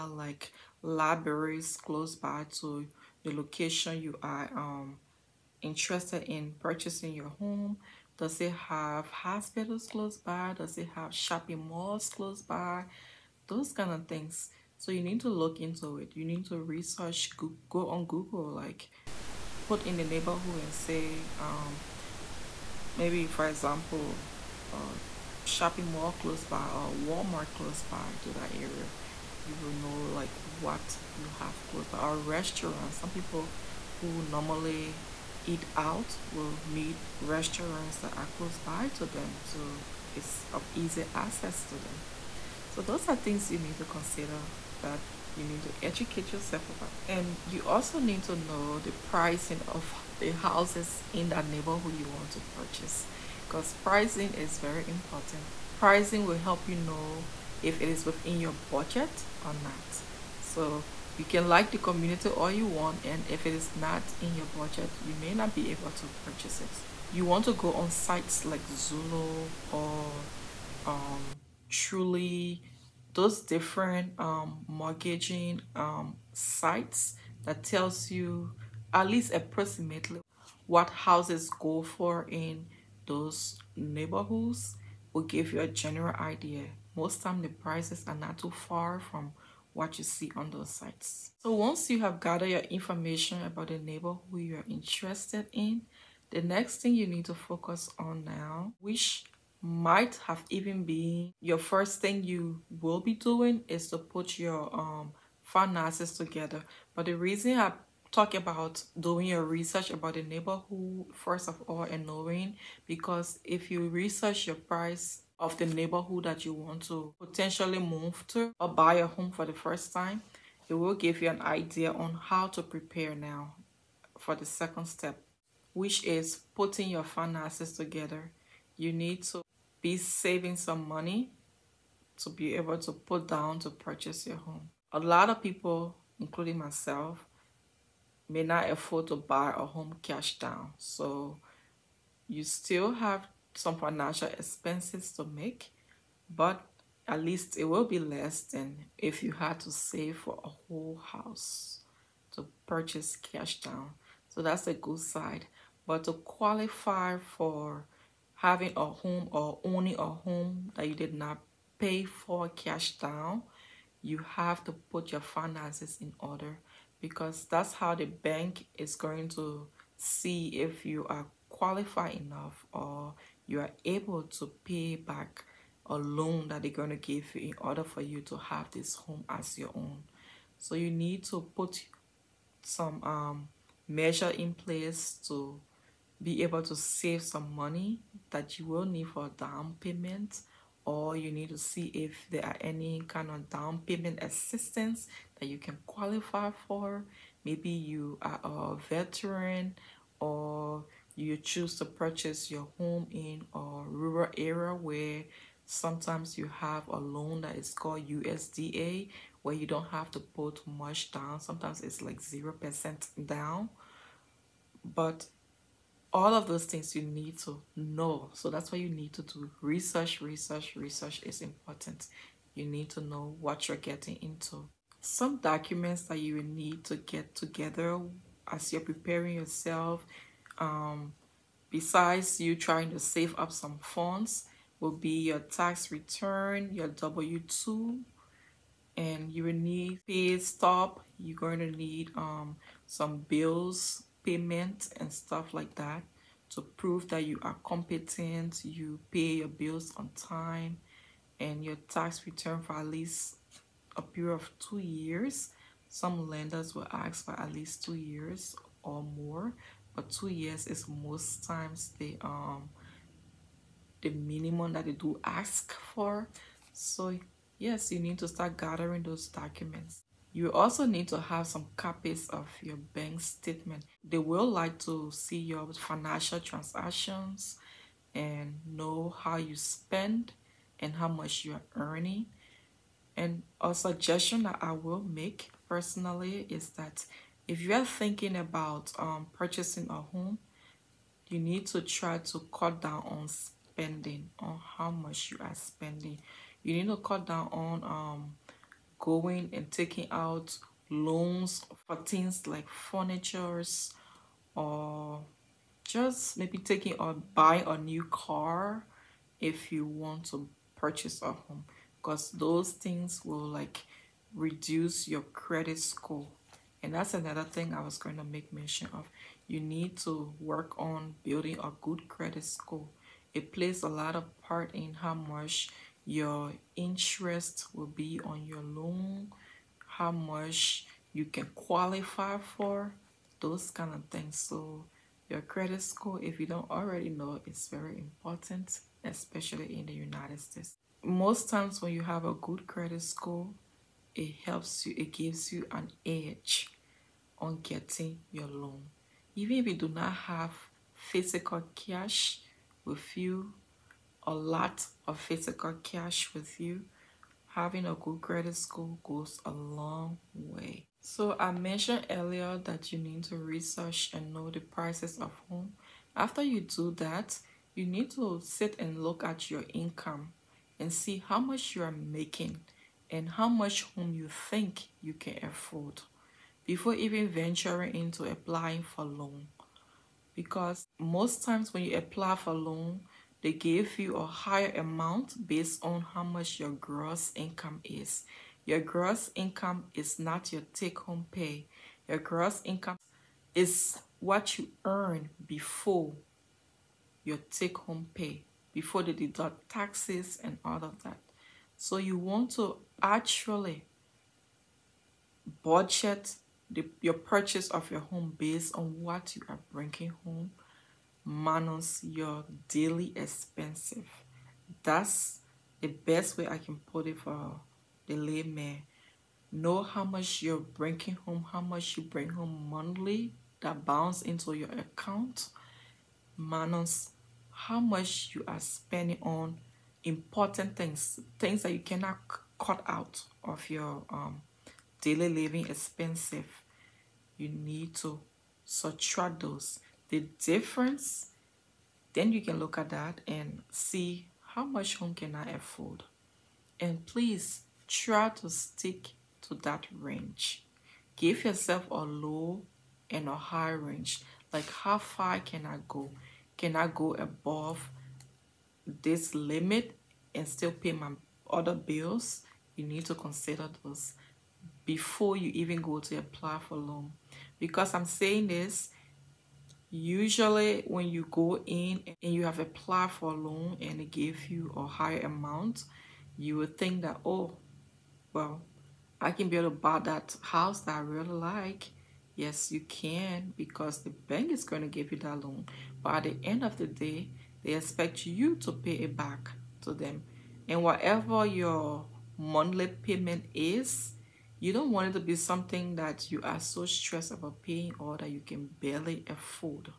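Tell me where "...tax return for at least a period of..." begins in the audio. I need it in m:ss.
4:11.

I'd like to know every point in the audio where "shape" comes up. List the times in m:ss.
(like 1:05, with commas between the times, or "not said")
not said.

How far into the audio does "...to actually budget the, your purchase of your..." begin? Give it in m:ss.
6:42.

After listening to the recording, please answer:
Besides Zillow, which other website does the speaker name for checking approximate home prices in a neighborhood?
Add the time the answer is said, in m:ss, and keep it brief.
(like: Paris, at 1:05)
Trulia, at 1:11.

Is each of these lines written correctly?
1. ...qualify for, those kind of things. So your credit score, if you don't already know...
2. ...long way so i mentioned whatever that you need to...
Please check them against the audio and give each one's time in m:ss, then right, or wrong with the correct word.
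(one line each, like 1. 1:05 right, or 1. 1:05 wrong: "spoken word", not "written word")
1. 5:31 right
2. 5:59 wrong: "earlier", not "whatever".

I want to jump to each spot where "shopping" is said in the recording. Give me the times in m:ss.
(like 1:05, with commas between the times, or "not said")
0:11, 0:25.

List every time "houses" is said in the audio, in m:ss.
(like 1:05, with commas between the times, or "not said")
0:50, 1:20, 2:31, 8:00.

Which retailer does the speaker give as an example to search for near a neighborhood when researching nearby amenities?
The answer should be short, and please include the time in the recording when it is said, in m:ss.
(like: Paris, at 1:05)
Walmart, at 0:26.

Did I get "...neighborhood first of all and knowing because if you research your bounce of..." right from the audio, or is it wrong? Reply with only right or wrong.
wrong.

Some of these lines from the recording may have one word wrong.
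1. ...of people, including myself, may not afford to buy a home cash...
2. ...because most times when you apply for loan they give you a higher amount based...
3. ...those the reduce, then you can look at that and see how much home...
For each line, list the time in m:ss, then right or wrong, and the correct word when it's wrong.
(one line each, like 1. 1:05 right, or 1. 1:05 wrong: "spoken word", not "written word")
1. 2:15 right
2. 6:20 right
3. 7:19 wrong: "difference", not "reduce".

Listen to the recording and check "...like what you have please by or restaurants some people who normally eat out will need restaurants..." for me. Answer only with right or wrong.
wrong.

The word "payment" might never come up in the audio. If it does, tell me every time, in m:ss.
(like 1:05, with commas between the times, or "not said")
3:09, 3:13, 4:04, 8:12.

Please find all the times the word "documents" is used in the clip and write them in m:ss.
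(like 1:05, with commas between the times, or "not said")
3:45, 4:29.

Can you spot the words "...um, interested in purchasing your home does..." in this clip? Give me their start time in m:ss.
0:04.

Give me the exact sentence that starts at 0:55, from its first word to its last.
Pricing will help you know if it is within your budget or not.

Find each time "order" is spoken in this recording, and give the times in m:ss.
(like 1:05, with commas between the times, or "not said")
2:46, 2:57.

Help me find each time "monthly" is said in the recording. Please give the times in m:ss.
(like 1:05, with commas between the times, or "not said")
7:02, 8:12.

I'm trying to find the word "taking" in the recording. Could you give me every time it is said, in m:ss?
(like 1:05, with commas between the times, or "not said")
4:59, 5:06.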